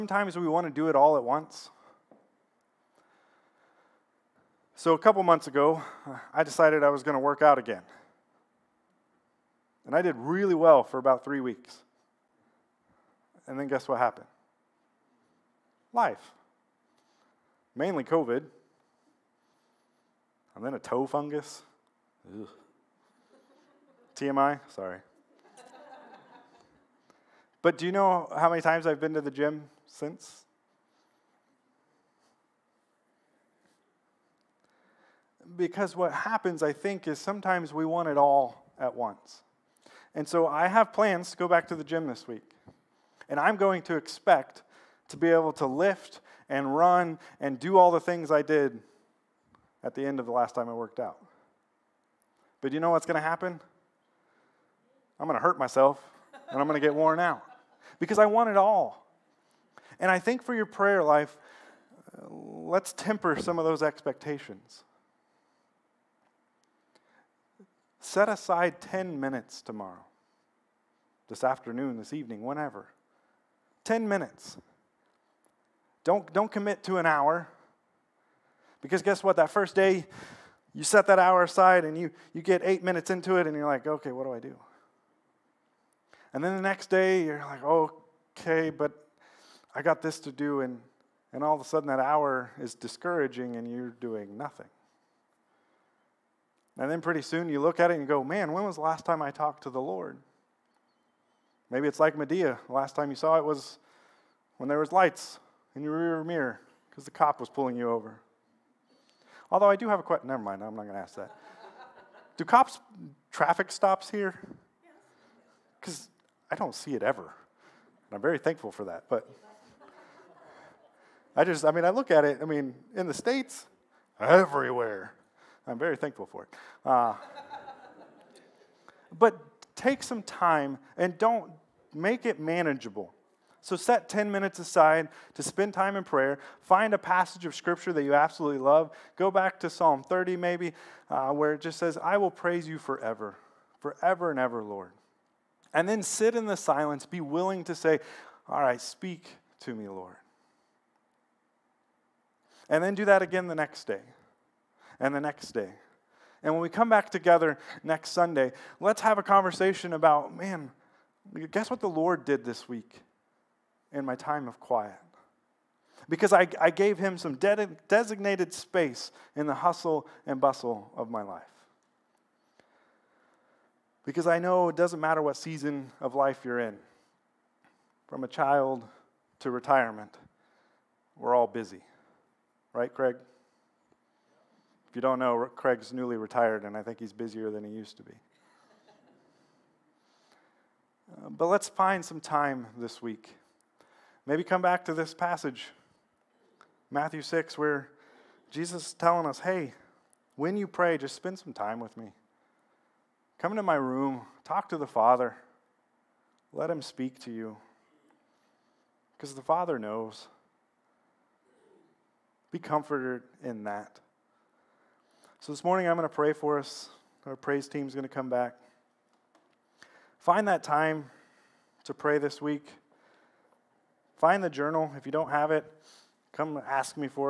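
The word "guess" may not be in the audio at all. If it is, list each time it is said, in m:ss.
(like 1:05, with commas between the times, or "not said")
0:13, 1:19, 2:41.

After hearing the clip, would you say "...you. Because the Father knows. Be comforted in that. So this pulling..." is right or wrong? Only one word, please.
wrong.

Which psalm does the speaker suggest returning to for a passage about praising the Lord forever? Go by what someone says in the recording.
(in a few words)
Psalm 30.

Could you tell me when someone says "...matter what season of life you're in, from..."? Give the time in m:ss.
2:55.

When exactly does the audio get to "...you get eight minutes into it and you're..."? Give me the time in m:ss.
1:22.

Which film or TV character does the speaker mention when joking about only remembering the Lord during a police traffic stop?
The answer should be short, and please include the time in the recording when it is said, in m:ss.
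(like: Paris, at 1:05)
Madea, at 1:42.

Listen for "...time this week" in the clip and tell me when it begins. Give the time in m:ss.
3:12.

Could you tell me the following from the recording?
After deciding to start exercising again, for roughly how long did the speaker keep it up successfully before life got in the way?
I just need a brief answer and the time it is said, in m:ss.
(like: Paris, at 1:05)
3 weeks, at 0:11.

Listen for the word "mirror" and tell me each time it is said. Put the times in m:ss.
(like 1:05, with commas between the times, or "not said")
1:46.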